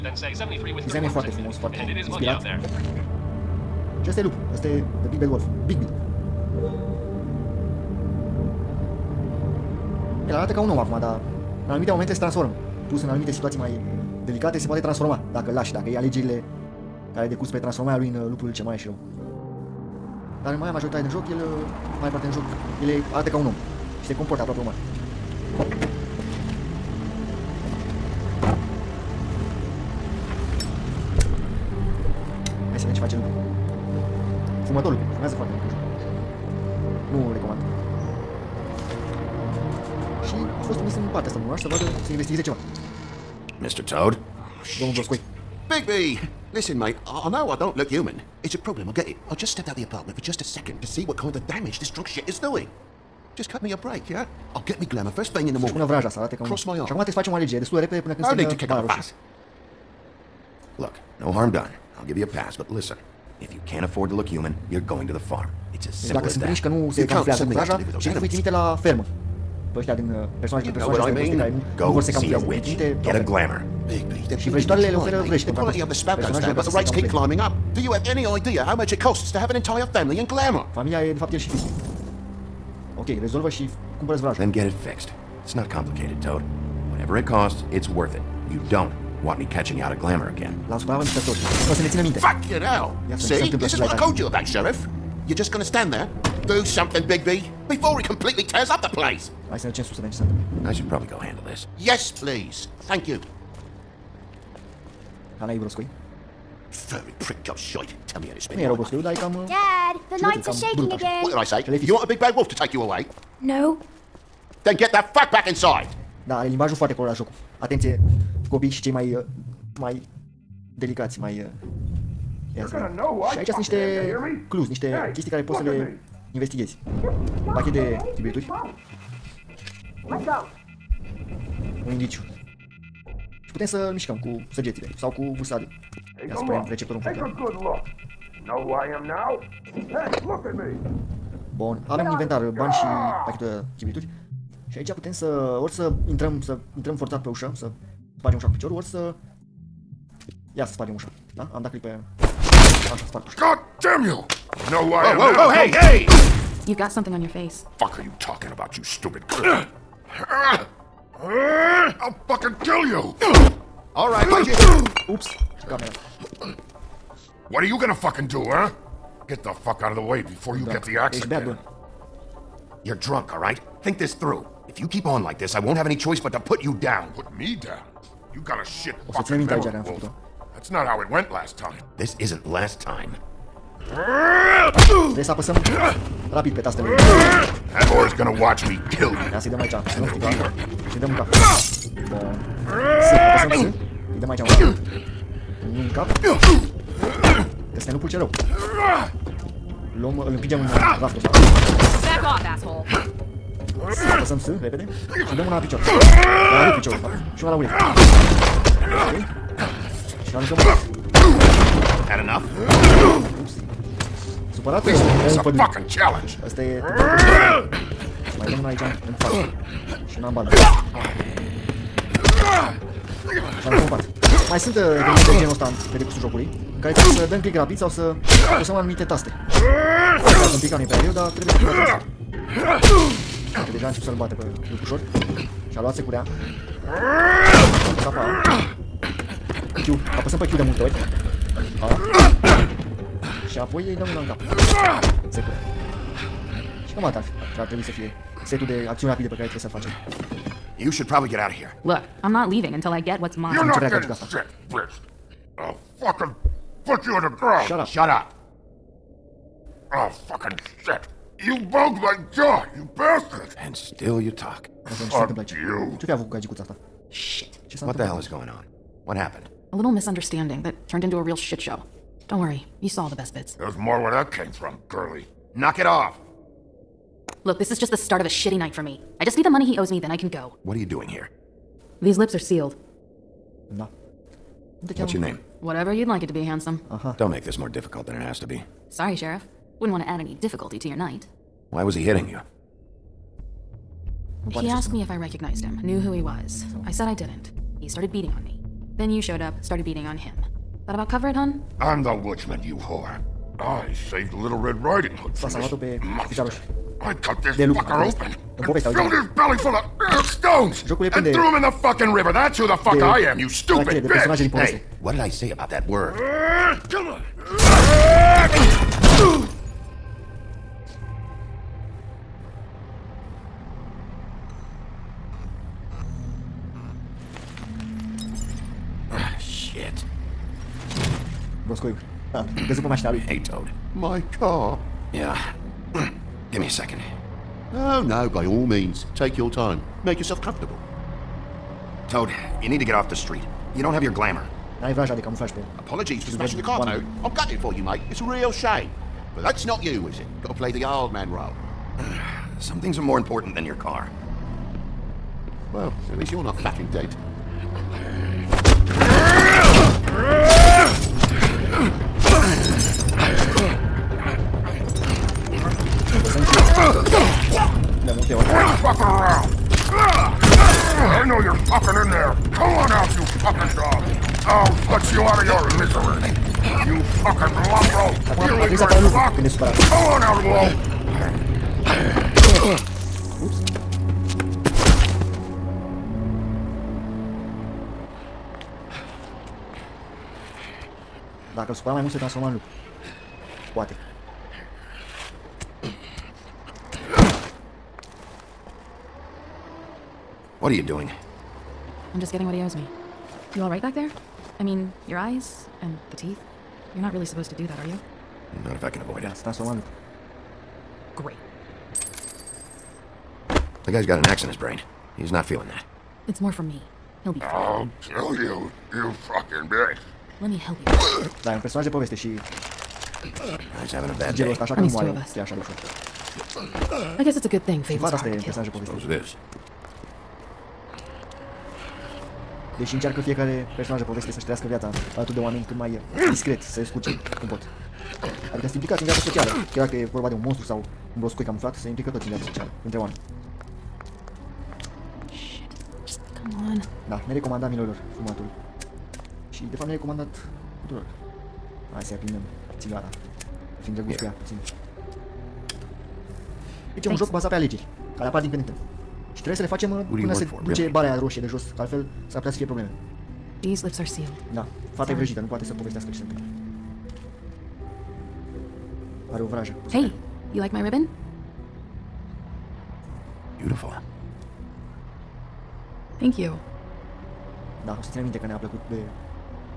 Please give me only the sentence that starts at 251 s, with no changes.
Look, I'm not leaving until I get what's mine.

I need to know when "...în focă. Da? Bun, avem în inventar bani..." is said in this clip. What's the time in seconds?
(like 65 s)
136 s.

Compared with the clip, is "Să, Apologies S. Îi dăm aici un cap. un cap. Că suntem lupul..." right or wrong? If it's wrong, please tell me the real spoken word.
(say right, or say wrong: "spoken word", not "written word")
wrong: "Apăsăm", not "Apologies".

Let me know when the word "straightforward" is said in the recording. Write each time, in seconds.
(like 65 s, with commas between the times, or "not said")
not said.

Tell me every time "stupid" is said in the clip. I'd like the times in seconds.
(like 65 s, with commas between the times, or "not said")
158 s, 313 s.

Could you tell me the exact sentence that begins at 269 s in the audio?
A little misunderstanding that turned into a real shit show.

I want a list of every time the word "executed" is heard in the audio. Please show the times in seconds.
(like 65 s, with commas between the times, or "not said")
not said.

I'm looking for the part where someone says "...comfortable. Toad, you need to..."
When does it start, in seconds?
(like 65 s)
340 s.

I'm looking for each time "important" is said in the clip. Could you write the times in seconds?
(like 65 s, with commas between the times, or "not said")
353 s.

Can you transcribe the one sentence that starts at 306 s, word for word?
I cut this de lup, fucker open.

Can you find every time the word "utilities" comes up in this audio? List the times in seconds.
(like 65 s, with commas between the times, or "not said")
not said.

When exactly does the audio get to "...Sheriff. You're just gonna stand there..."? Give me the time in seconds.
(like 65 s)
94 s.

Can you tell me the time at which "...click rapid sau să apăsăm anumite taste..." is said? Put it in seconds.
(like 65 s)
227 s.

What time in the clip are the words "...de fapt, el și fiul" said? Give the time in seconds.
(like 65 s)
81 s.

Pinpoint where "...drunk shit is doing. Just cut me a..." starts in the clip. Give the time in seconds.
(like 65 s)
51 s.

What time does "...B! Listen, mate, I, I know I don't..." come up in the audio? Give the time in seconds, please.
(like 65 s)
45 s.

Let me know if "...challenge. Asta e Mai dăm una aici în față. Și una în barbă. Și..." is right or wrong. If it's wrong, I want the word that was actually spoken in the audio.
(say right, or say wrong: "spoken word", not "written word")
right.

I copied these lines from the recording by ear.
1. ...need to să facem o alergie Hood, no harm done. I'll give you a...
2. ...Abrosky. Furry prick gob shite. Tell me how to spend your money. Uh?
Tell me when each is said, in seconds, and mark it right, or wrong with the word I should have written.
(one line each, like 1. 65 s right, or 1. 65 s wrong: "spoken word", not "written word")
1. 56 s wrong: "Look", not "Hood"
2. 105 s right.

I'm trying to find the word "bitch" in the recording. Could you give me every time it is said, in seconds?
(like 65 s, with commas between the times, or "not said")
254 s, 313 s, 419 s.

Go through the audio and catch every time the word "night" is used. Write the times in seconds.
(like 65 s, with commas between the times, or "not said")
278 s, 290 s.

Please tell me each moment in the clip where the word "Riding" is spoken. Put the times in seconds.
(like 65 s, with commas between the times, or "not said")
304 s.